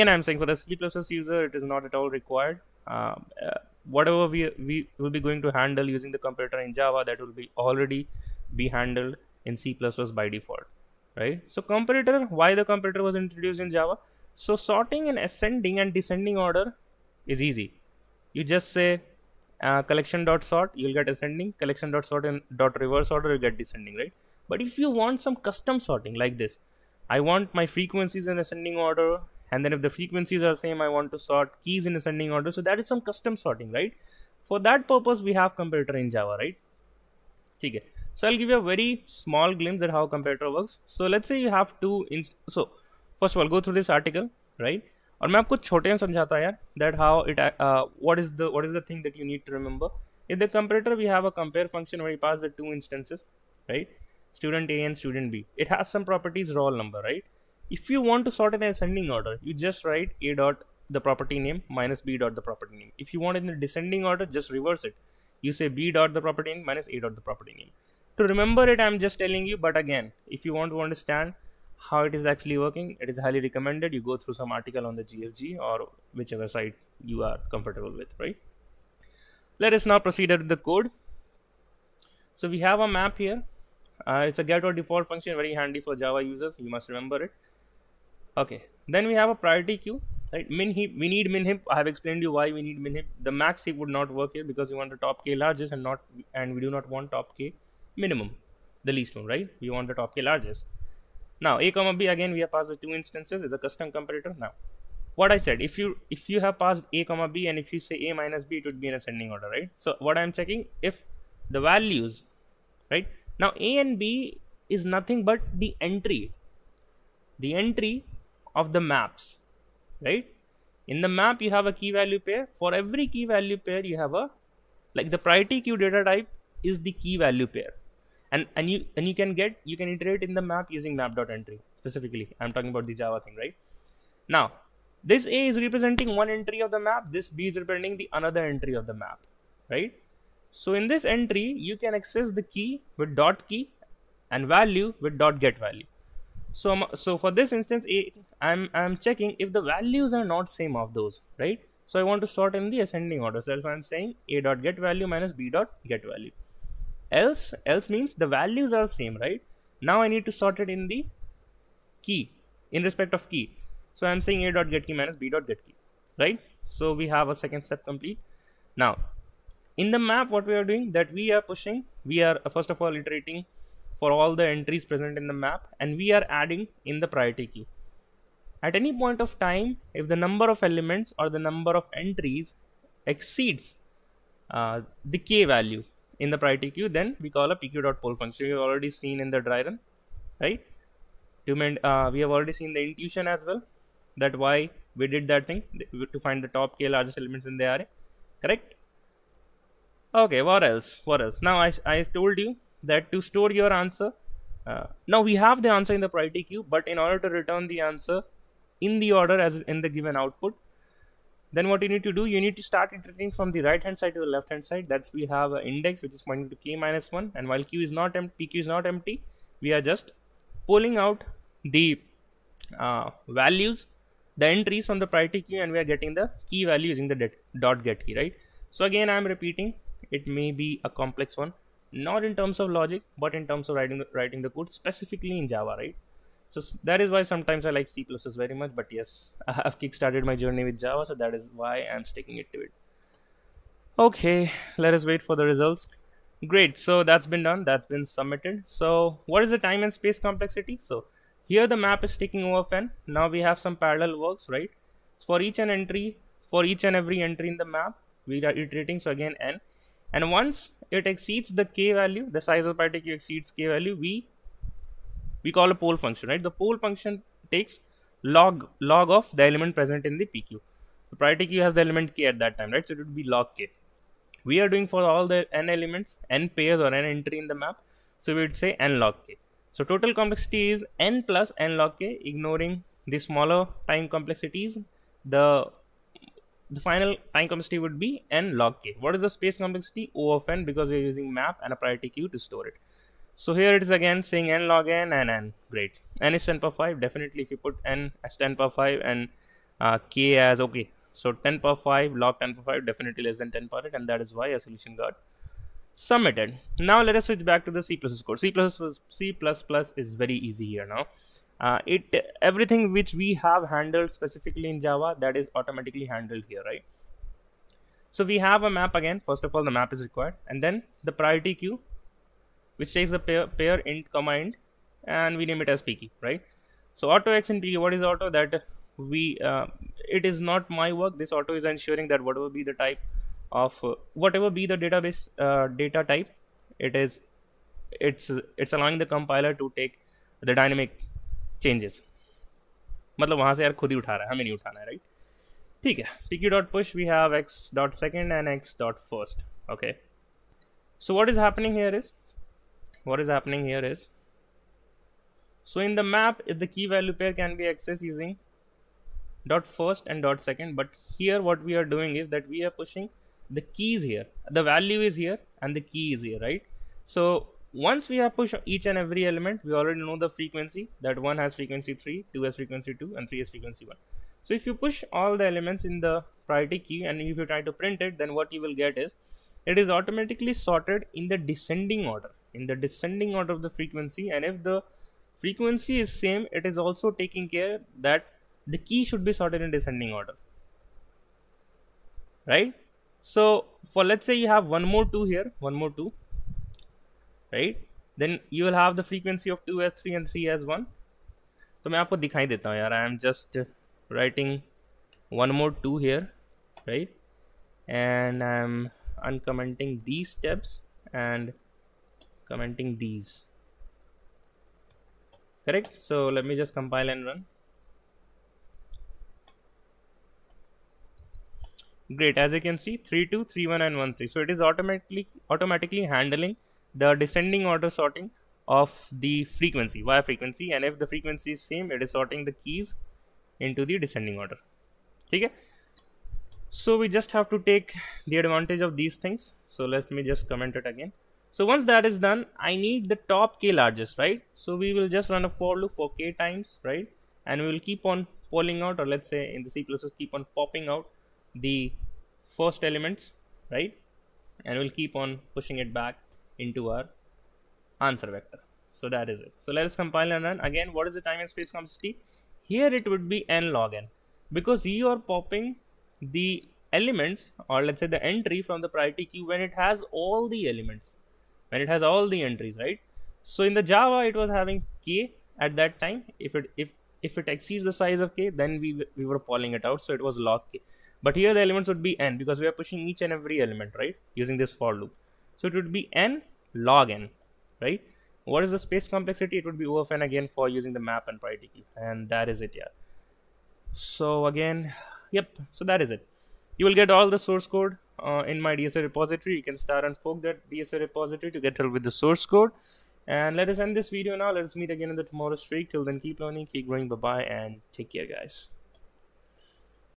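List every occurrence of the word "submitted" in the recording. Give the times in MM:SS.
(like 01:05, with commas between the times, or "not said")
04:08, 05:05.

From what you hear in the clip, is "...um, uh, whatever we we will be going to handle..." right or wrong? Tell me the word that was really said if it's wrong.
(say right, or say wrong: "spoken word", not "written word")
right.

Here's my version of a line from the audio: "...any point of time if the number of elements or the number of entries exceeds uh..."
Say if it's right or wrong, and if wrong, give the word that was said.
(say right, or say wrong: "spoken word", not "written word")
right.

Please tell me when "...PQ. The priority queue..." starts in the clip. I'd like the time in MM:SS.
04:30.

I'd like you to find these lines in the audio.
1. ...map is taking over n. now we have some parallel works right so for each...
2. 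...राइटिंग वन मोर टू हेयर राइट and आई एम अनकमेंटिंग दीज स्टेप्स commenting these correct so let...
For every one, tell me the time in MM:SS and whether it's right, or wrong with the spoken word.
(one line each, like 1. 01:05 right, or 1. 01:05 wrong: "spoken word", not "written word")
1. 04:11 right
2. 06:44 right.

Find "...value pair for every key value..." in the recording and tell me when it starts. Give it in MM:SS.
02:01.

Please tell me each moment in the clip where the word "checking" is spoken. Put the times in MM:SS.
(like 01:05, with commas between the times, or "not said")
01:50, 02:29.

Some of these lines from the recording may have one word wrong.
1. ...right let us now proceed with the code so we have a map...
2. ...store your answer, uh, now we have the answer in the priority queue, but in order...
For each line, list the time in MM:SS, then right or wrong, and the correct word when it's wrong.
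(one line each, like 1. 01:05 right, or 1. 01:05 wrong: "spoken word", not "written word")
1. 01:18 right
2. 03:23 right.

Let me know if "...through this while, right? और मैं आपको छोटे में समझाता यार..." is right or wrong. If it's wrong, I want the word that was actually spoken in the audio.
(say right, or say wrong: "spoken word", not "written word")
wrong: "article", not "while".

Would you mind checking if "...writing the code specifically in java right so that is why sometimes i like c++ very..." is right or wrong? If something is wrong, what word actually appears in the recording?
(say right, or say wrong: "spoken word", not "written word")
right.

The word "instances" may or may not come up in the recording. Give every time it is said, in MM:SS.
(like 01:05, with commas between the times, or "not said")
01:42, 02:27.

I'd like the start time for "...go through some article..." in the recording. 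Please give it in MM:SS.
01:14.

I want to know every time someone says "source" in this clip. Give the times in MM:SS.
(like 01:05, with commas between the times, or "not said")
08:17, 08:22.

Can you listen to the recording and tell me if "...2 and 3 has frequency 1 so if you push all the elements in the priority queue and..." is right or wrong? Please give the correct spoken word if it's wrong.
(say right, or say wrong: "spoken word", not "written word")
right.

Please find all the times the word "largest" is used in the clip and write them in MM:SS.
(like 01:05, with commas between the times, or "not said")
01:35, 01:40, 03:16, 07:23.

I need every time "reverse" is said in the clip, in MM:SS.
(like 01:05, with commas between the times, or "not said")
00:22, 01:04.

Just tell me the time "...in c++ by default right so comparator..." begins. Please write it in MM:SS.
00:09.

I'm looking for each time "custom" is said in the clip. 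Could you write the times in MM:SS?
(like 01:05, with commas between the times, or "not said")
00:25, 00:33, 01:43.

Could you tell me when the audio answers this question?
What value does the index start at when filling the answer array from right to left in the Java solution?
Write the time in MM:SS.
03:36.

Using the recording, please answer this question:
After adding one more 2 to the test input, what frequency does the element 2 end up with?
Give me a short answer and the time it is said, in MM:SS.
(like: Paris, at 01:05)
3, at 06:39.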